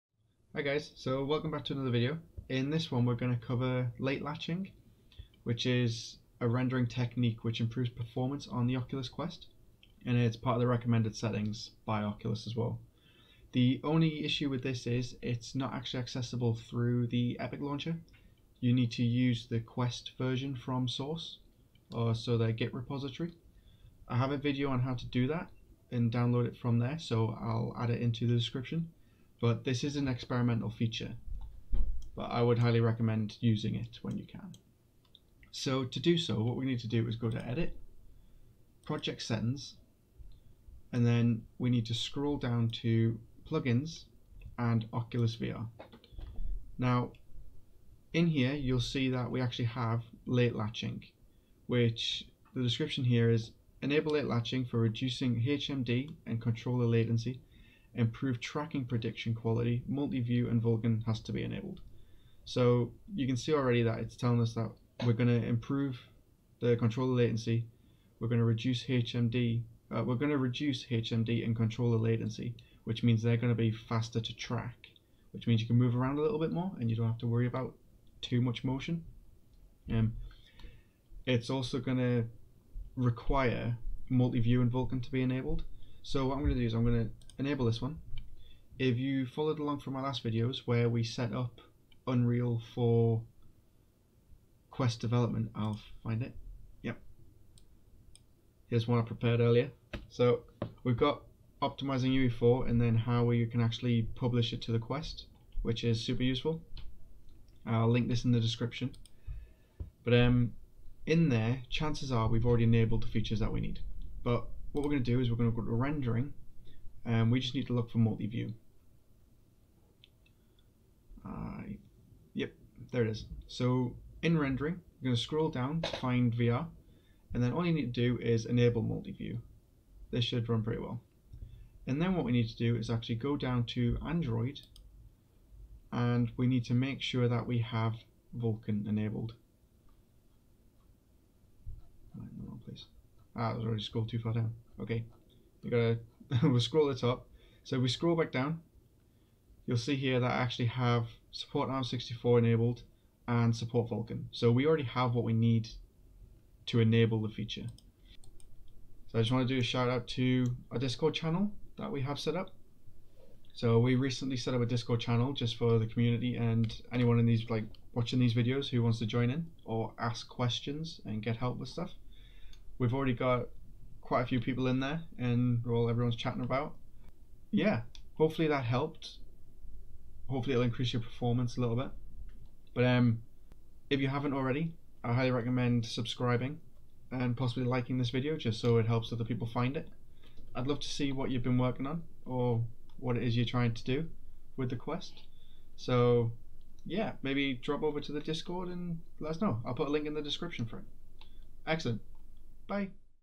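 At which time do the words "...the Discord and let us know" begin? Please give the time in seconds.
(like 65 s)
198 s.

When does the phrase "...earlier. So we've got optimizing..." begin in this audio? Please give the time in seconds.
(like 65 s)
99 s.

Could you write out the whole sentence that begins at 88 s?
If you followed along from my last videos where we set up Unreal for quest development, I'll find it.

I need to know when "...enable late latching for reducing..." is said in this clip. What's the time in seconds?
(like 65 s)
53 s.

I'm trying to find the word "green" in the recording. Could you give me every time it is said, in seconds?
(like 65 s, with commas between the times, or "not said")
not said.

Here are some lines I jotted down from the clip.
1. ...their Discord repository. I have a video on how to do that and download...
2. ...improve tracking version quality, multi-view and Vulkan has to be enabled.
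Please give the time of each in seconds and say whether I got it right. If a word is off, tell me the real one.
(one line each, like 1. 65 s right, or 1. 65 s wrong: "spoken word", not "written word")
1. 22 s wrong: "Git", not "Discord"
2. 57 s wrong: "prediction", not "version".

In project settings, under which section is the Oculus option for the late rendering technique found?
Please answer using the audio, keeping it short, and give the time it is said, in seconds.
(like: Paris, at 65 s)
Oculus VR, at 44 s.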